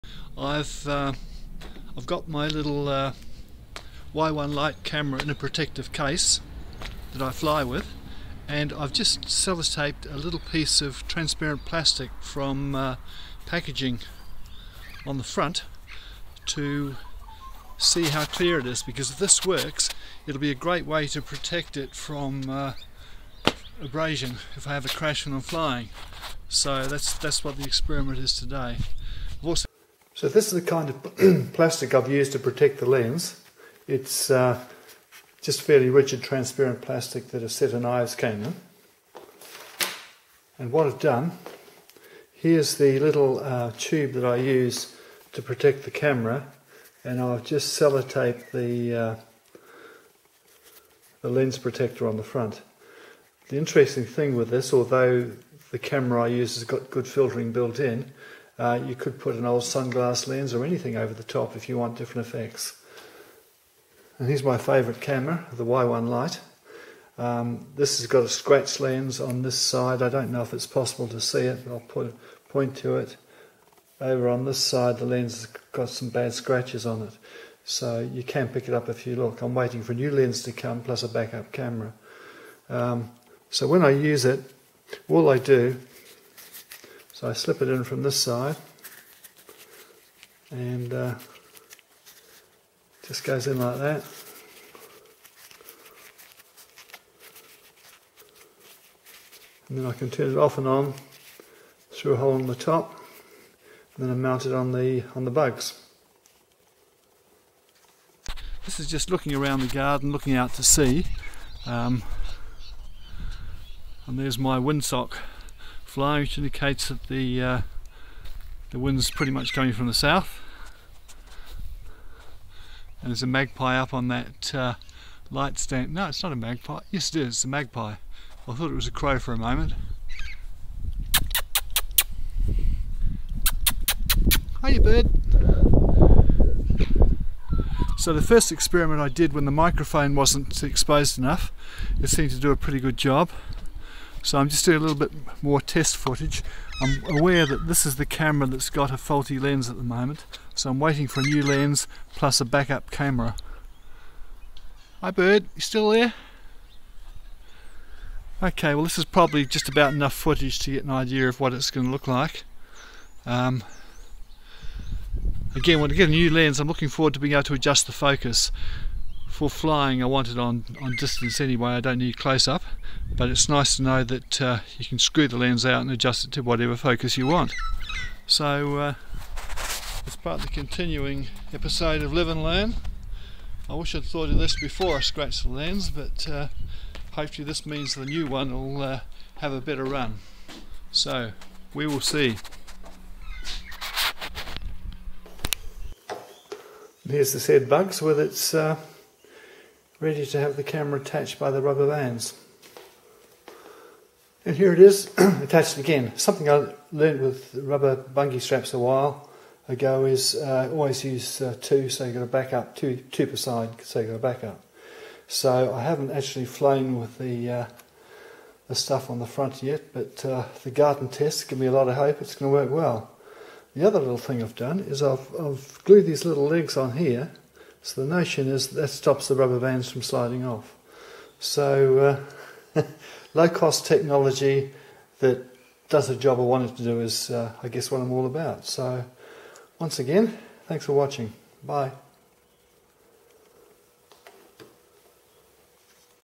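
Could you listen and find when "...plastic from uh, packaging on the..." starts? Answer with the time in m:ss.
0:11.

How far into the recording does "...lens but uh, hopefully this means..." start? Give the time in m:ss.
3:05.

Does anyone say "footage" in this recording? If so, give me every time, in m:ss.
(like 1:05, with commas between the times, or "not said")
2:25, 2:40.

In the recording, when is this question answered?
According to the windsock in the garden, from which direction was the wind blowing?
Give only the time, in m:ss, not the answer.
1:59.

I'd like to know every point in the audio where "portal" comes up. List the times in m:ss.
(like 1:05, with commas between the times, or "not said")
not said.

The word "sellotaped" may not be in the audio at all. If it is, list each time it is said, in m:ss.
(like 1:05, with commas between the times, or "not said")
0:09, 0:47.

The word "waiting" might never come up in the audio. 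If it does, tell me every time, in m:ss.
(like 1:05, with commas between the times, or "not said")
1:19, 2:30.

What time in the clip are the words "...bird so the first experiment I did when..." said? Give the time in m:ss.
2:14.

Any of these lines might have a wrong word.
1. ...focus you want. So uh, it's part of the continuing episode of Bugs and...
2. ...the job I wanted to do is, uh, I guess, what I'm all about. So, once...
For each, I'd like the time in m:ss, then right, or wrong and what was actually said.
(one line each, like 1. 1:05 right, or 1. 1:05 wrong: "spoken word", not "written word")
1. 2:56 wrong: "Live", not "Bugs"
2. 3:56 right.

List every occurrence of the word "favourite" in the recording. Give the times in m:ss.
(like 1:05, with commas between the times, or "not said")
1:04.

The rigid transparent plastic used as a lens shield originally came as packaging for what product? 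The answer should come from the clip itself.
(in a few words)
a set of knives.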